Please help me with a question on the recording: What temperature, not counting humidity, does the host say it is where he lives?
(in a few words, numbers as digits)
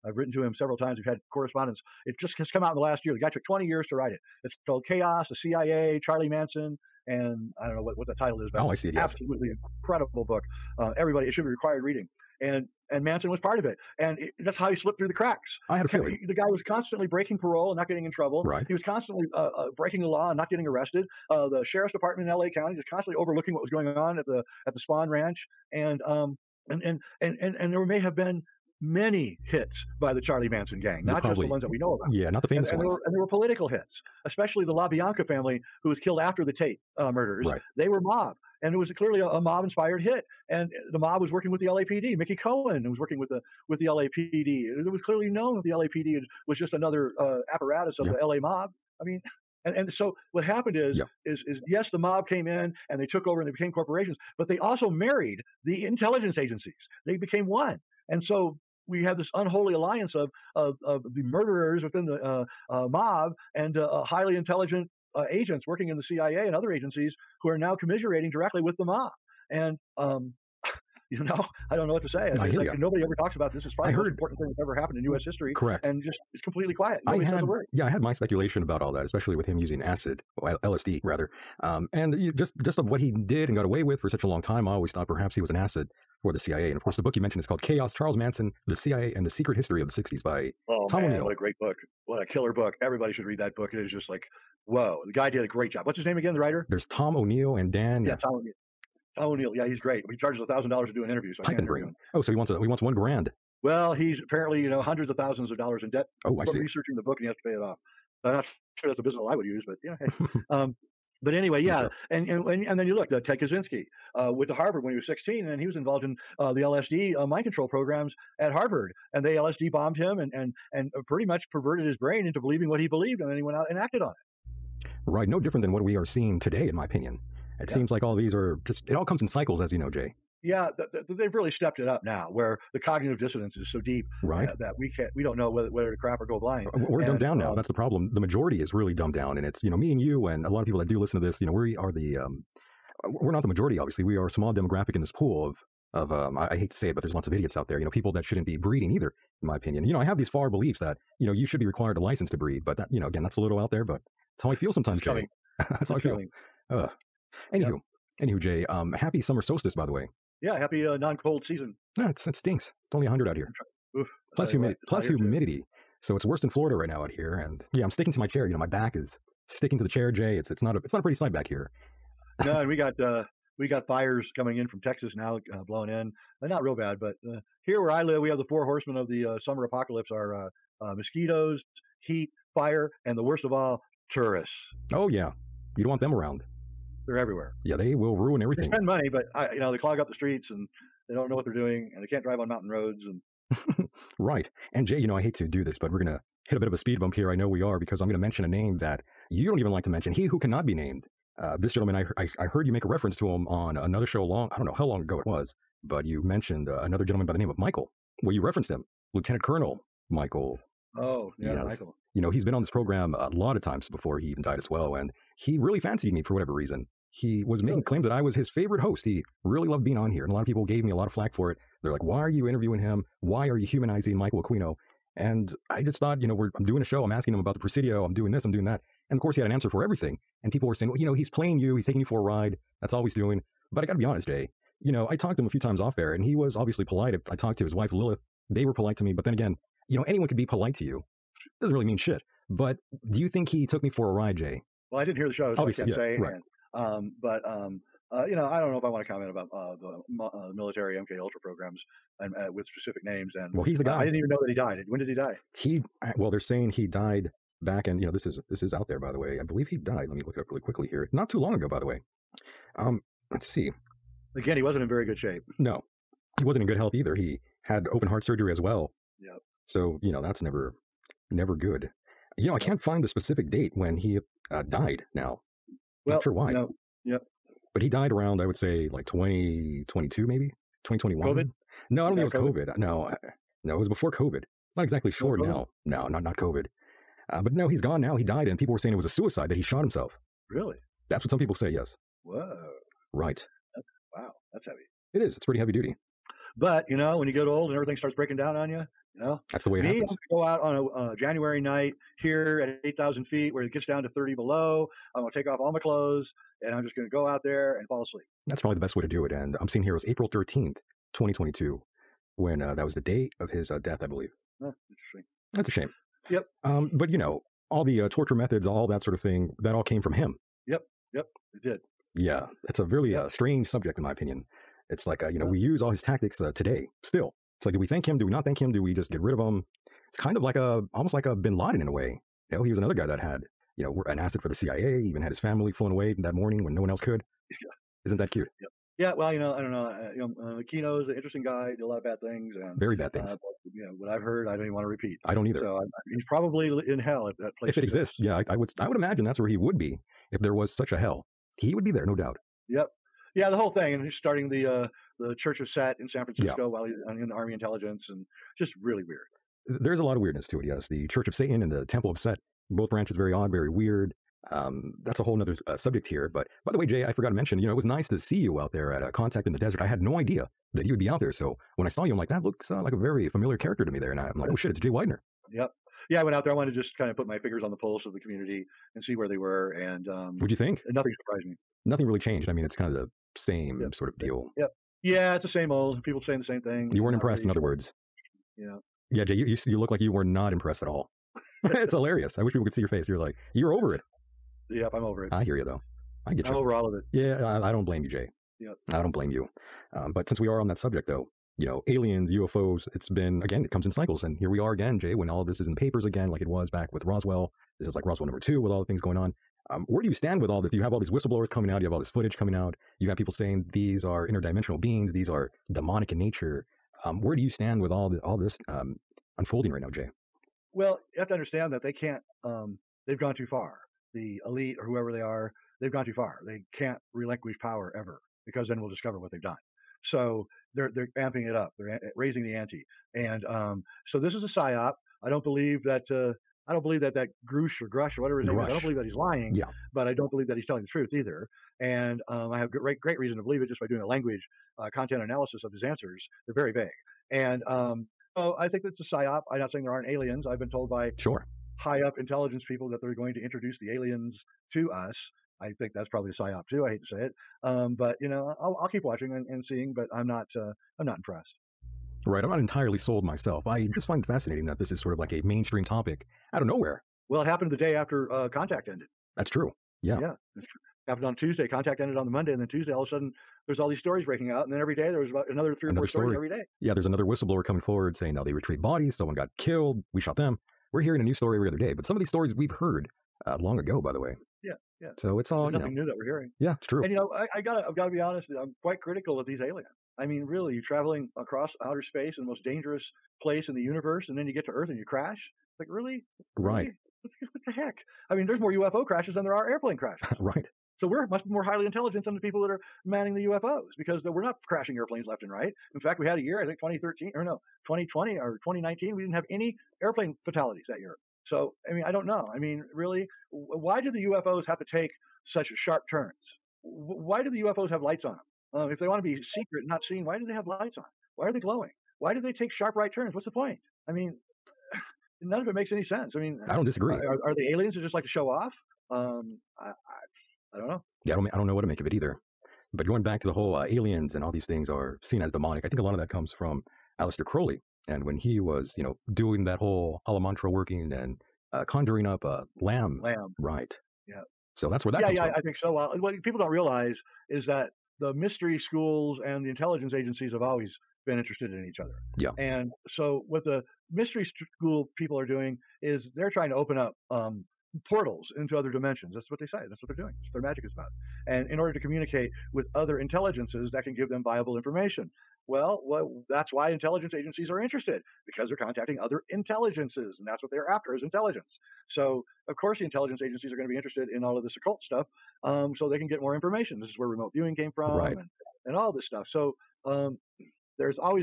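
100.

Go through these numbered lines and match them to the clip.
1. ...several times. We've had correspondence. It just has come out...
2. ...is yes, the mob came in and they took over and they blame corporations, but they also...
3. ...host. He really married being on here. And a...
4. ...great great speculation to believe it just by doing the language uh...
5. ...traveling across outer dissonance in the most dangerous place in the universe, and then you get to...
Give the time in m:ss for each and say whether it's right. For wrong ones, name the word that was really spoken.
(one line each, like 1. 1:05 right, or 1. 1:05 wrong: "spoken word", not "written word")
1. 0:00 right
2. 0:51 wrong: "became", not "blame"
3. 3:38 wrong: "loved", not "married"
4. 7:22 wrong: "reason", not "speculation"
5. 8:10 wrong: "space", not "dissonance".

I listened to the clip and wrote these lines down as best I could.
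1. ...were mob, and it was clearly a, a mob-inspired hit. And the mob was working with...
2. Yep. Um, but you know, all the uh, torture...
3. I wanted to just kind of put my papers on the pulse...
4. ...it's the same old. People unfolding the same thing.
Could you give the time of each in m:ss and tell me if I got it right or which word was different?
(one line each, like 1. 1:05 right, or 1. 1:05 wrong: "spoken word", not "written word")
1. 0:37 right
2. 5:16 right
3. 6:16 wrong: "fingers", not "papers"
4. 6:25 wrong: "saying", not "unfolding".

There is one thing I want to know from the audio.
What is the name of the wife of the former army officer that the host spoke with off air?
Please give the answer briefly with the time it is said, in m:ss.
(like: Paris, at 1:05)
Lilith, at 3:57.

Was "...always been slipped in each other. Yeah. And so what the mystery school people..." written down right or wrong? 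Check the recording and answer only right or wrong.
wrong.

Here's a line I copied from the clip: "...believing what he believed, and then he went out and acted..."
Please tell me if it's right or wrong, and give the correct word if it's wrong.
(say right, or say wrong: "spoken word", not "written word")
right.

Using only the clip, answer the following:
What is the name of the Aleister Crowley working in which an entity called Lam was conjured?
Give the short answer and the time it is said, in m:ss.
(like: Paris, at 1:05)
Amalantrah working, at 9:00.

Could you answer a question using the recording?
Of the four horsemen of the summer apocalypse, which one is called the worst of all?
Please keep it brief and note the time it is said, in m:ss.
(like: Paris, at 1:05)
Tourists, at 3:04.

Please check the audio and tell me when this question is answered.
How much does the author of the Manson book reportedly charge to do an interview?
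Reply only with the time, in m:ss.
1:40.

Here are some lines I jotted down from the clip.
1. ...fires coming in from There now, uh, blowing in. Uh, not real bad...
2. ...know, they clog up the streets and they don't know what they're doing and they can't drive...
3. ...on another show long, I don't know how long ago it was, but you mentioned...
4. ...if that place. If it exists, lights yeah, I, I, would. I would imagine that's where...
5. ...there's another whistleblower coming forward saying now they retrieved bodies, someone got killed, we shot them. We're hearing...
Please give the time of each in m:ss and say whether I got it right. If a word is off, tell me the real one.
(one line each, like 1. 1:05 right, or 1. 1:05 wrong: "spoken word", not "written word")
1. 2:53 wrong: "Texas", not "There"
2. 3:09 right
3. 3:23 right
4. 5:47 wrong: "exists", not "lights"
5. 7:56 right.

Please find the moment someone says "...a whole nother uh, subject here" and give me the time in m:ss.
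6:05.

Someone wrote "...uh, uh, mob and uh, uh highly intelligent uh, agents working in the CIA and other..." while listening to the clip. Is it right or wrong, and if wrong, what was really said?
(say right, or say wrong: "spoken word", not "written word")
right.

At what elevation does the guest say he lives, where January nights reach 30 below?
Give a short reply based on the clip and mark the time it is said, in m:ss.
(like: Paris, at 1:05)
8,000 feet, at 5:02.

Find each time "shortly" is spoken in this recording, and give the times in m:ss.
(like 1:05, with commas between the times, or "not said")
not said.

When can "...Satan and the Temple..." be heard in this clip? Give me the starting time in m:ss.
6:01.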